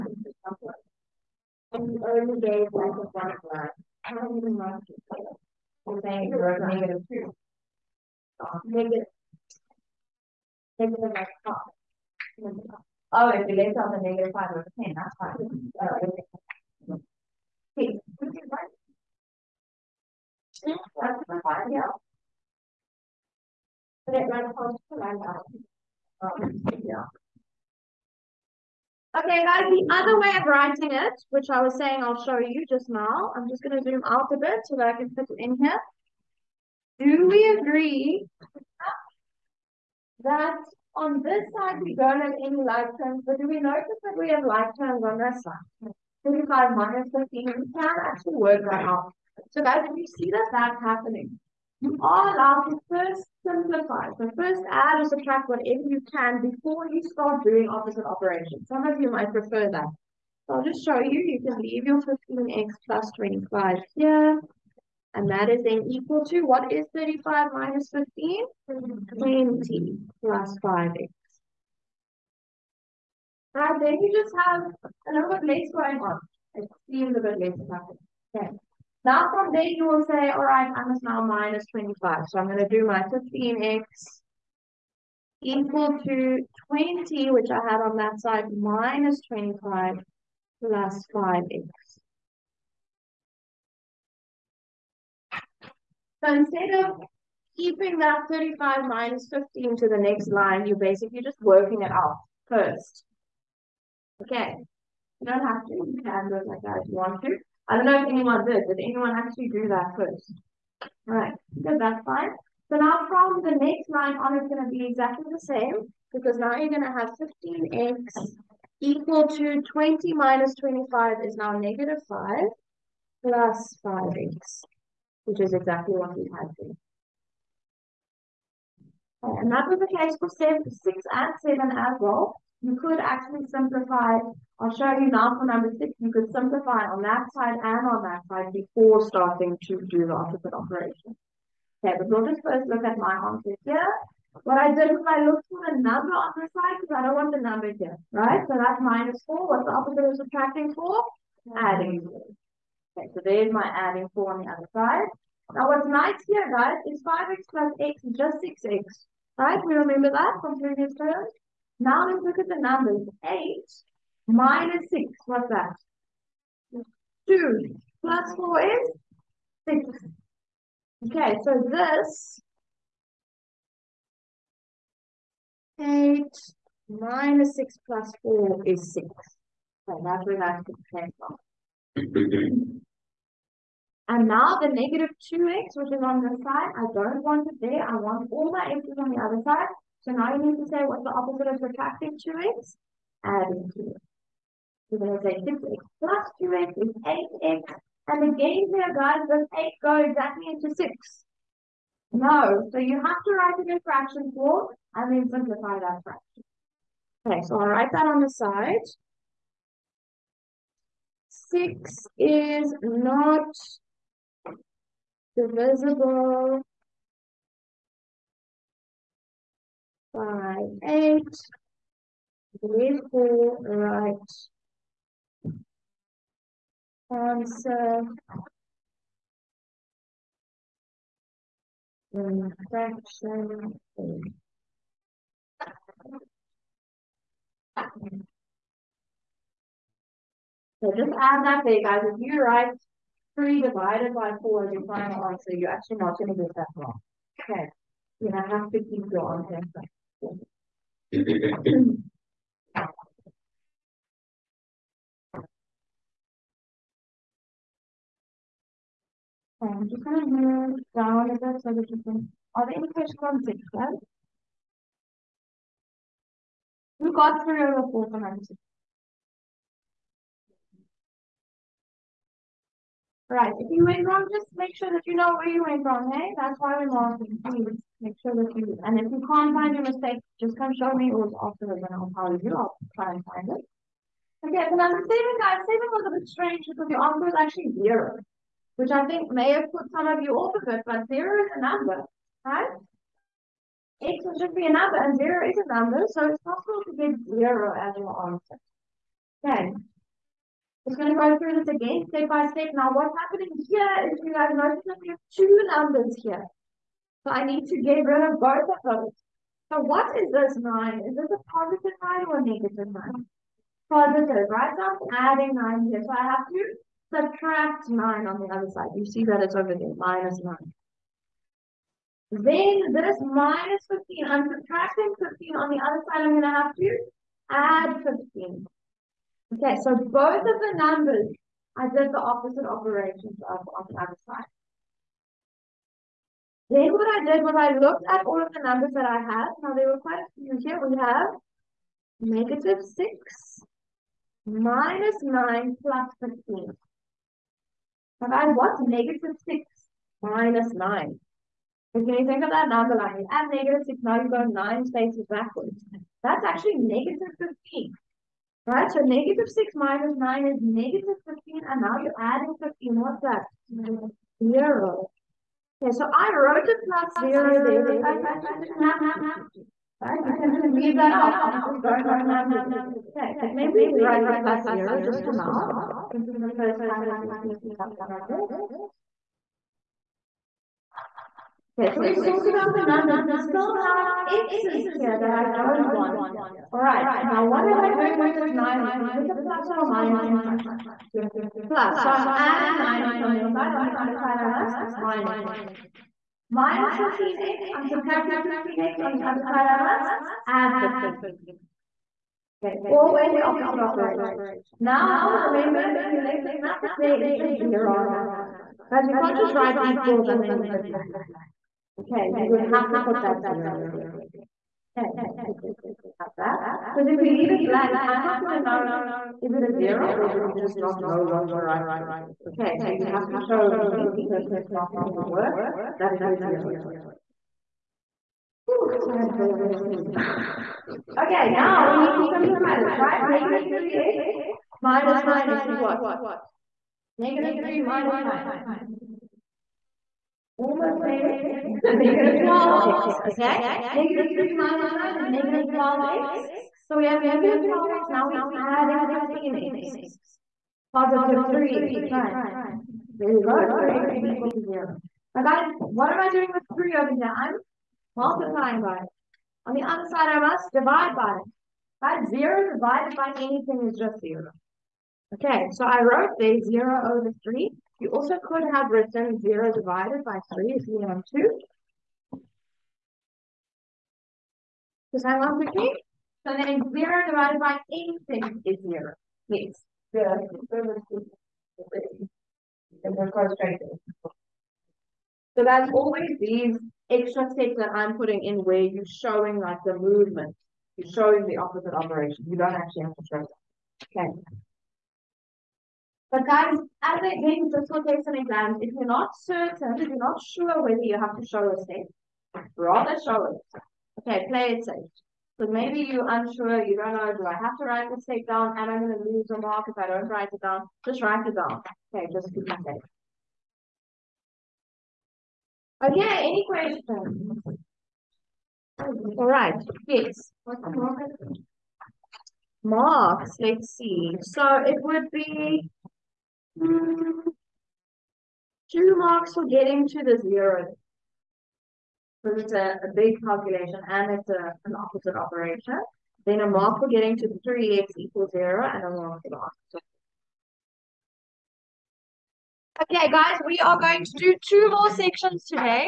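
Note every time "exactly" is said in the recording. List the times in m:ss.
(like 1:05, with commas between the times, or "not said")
1:54, 2:05, 3:20.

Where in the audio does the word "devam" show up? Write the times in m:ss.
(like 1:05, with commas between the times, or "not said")
4:20.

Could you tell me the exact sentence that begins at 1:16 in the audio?
It seems a bit less nothing.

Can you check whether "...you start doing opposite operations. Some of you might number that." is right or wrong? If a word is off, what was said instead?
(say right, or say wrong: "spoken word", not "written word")
wrong: "prefer", not "number".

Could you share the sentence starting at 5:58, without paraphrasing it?
Right, so negative 6 minus 9 is negative 15, and now you're adding 15.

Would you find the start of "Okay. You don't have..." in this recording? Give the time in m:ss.
1:44.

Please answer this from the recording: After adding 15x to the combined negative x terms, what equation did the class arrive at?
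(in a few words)
3x = 0.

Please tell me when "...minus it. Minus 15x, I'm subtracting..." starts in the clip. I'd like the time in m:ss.
6:34.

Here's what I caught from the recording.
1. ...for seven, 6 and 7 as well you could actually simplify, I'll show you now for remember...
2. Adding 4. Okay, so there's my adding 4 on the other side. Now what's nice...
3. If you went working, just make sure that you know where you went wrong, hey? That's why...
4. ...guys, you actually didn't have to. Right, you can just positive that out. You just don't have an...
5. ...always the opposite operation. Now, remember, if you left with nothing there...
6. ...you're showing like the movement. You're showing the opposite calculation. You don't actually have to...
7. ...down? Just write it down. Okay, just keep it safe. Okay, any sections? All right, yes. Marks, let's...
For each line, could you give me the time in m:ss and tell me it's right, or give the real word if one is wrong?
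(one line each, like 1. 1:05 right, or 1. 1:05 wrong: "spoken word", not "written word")
1. 2:10 wrong: "number", not "remember"
2. 2:31 right
3. 4:33 wrong: "wrong", not "working"
4. 6:07 wrong: "leave", not "positive"
5. 6:42 right
6. 8:08 wrong: "operation", not "calculation"
7. 8:30 wrong: "questions", not "sections".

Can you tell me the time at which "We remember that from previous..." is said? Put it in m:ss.
2:39.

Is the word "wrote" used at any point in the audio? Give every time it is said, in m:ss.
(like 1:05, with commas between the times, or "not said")
6:06, 7:46.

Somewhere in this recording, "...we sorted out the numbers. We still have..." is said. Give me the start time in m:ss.
6:22.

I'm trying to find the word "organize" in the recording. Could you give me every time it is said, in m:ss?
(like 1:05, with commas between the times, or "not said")
not said.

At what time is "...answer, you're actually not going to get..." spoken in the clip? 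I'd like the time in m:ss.
4:05.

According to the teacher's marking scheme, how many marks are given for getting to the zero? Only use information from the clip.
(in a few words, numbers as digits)
2.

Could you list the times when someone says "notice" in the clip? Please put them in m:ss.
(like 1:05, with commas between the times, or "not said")
0:43, 5:04.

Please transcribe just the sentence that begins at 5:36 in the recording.
Then what I did was I looked at all of the numbers that I had.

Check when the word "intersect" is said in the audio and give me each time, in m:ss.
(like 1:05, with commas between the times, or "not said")
not said.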